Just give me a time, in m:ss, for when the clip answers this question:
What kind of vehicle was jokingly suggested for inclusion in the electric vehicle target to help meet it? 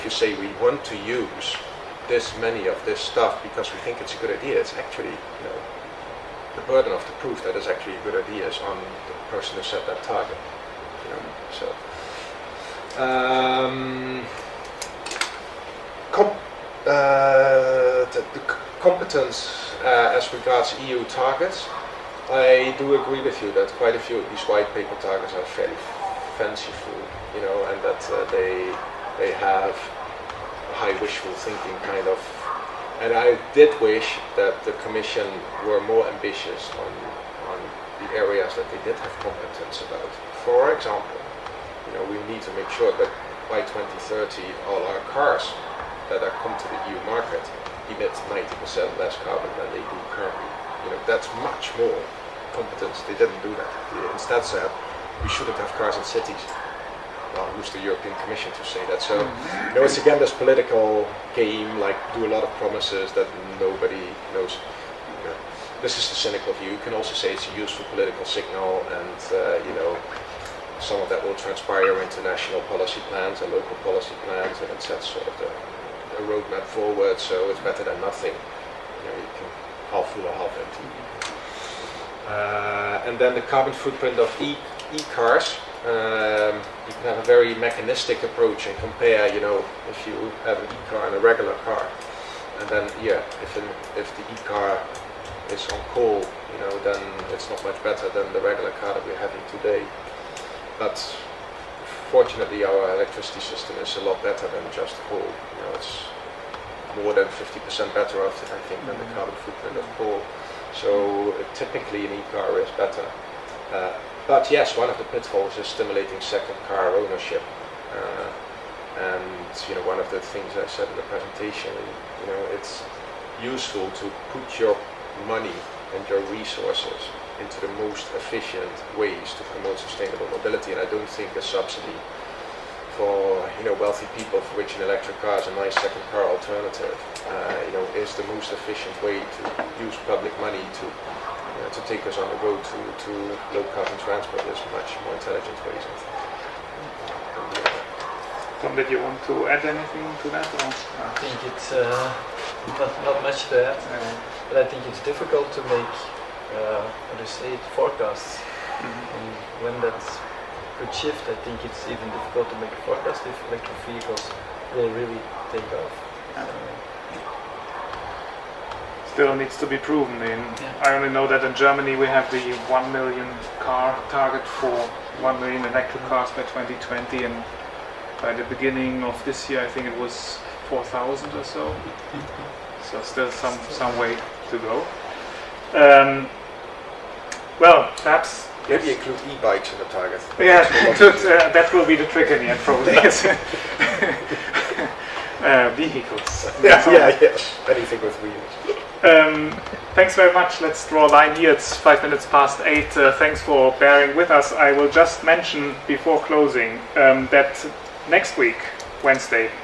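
3:09.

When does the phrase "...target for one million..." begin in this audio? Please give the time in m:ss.
2:54.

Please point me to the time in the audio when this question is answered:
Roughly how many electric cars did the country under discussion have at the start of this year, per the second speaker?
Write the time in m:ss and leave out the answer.
3:00.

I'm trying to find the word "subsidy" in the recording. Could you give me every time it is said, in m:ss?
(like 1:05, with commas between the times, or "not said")
2:11.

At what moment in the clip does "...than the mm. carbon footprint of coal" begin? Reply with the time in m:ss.
1:48.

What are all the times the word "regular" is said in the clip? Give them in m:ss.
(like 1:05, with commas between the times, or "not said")
1:31, 1:38.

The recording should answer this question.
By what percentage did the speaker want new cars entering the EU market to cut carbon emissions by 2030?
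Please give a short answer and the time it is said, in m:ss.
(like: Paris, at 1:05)
90%, at 0:48.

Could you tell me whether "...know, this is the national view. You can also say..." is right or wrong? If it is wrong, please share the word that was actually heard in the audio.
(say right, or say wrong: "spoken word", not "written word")
wrong: "cynical", not "national".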